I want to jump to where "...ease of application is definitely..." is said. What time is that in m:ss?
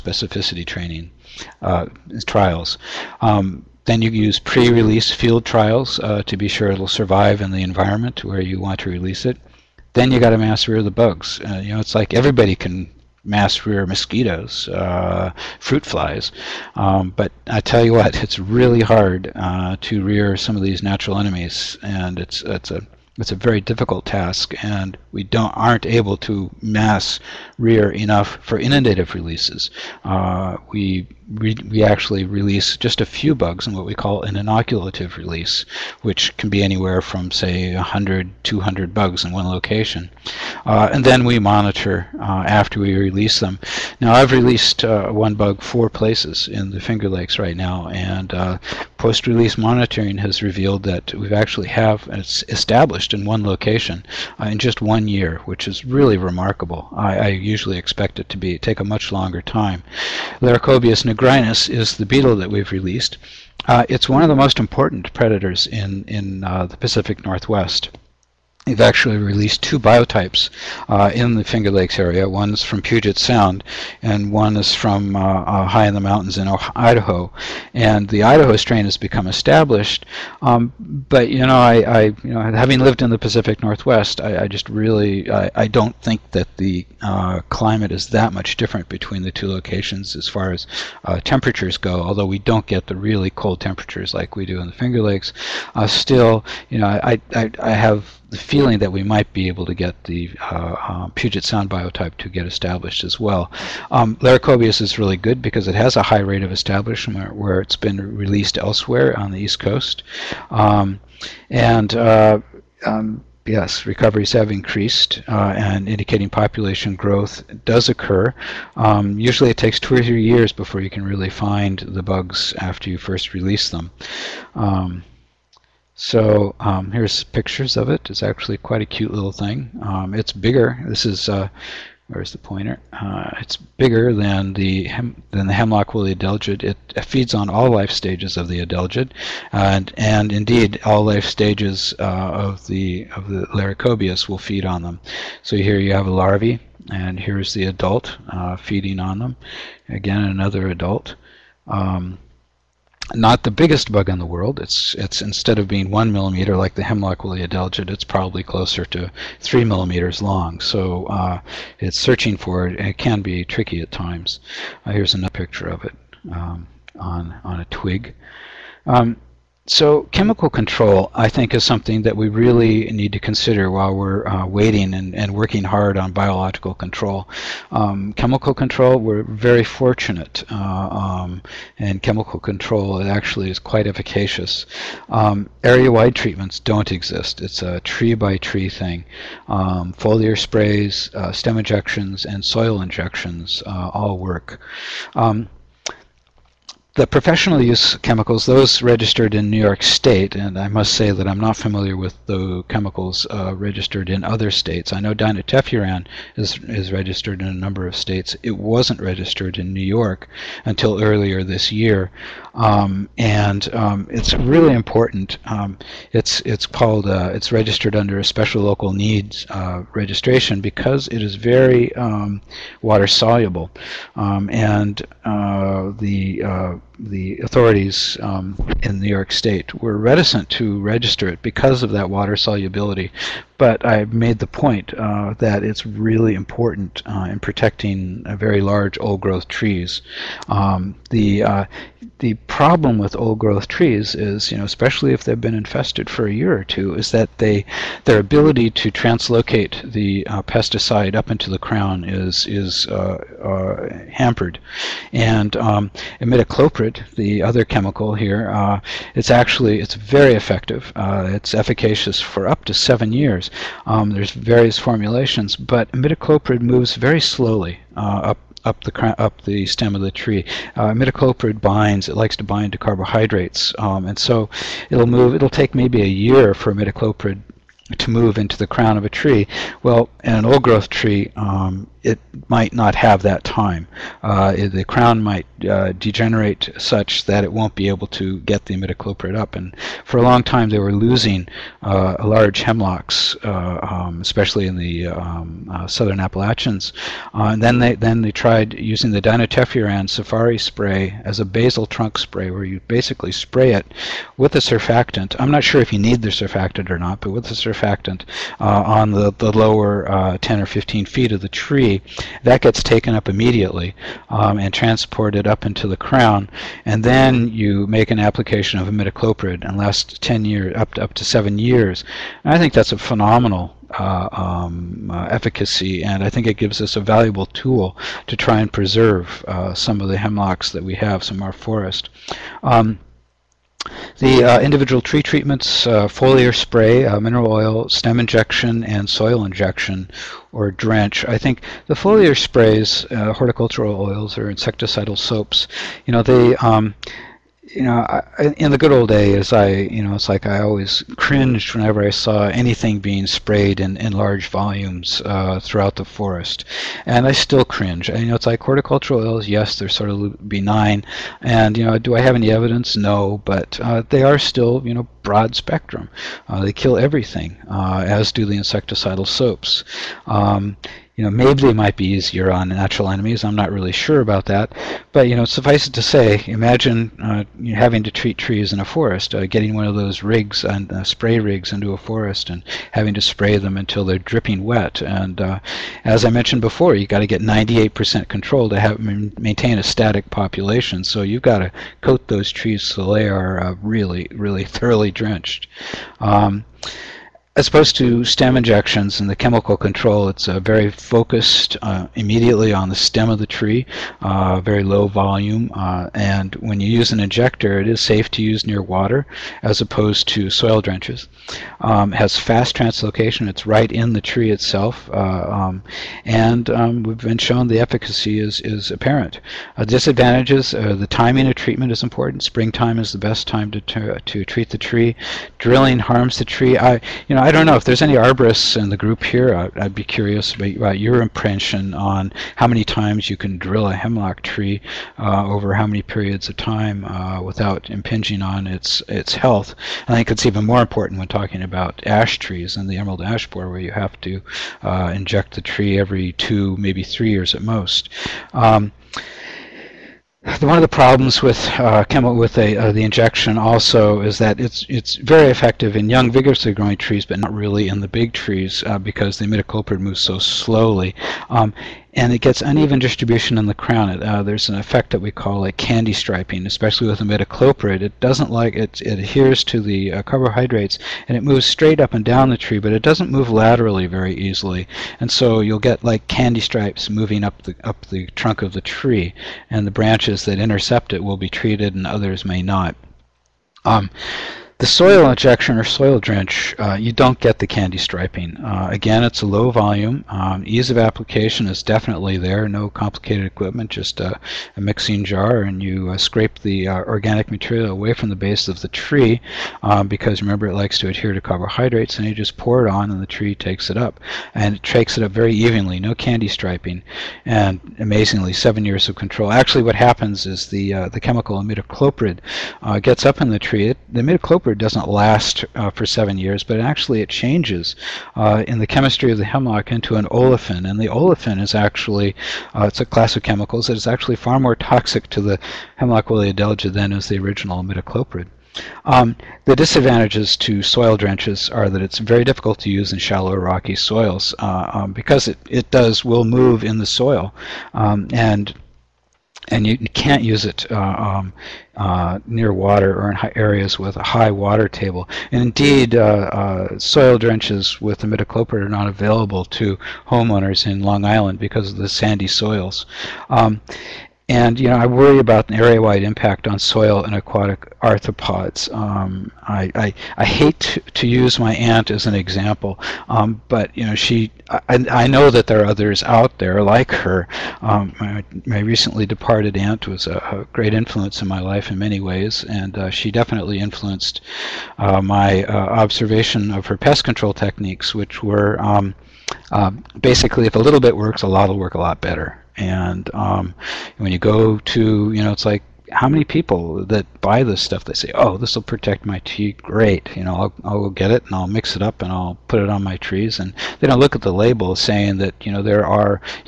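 8:10.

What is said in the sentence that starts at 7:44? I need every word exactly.
It, uh, there's an effect that we call a candy striping, especially with imidacloprid.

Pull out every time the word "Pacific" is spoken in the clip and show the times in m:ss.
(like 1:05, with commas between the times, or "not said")
1:06, 1:23.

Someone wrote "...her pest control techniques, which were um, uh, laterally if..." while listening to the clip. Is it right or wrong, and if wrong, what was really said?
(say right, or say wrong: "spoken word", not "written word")
wrong: "basically", not "laterally".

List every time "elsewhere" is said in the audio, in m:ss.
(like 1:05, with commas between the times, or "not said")
1:48.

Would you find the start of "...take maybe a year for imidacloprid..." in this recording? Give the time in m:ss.
4:35.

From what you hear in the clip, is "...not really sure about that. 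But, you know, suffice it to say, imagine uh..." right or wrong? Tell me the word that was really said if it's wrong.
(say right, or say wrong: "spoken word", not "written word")
right.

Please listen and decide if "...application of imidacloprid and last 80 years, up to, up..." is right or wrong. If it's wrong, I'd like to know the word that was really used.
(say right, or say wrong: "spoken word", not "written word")
wrong: "10", not "80".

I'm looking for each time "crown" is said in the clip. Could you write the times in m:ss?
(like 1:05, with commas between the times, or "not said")
4:11, 4:38, 4:44, 5:15, 7:43.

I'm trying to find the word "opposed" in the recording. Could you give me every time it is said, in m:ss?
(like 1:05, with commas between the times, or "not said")
6:37, 6:49.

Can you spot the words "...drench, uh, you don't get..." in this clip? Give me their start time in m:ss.
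8:06.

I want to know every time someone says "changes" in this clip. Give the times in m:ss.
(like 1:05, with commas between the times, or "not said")
8:37.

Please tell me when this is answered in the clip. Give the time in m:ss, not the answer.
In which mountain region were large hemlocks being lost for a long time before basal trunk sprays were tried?
4:55.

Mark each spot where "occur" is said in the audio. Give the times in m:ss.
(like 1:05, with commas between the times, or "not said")
1:57.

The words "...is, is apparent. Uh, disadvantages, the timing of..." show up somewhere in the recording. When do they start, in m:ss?
6:58.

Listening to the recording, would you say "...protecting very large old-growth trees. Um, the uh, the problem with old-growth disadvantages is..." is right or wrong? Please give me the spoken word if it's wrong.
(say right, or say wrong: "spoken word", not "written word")
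wrong: "trees", not "disadvantages".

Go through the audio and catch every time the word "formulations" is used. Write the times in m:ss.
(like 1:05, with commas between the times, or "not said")
4:24.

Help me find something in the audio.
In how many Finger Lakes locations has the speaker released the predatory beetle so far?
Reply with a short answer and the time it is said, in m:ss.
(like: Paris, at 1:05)
4, at 0:45.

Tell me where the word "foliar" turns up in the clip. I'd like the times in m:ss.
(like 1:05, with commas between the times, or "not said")
3:09, 5:36, 5:41.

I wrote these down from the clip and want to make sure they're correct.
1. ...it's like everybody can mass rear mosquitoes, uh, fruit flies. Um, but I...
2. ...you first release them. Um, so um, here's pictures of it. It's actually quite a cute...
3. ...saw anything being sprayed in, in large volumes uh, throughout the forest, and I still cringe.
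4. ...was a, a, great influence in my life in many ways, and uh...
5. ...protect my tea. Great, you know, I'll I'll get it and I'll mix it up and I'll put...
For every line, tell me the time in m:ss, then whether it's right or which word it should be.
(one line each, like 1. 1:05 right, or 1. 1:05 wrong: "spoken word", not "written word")
1. 0:11 right
2. 2:02 right
3. 5:52 right
4. 9:30 right
5. 9:48 right.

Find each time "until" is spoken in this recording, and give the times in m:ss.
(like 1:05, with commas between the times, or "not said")
3:30, 6:23.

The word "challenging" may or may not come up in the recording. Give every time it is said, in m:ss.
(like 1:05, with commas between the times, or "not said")
not said.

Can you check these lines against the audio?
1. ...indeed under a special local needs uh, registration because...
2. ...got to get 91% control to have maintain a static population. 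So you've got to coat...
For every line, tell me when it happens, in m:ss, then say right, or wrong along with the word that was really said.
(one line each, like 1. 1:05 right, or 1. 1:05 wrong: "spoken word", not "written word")
1. 3:37 wrong: "registered", not "indeed"
2. 6:27 wrong: "98", not "91".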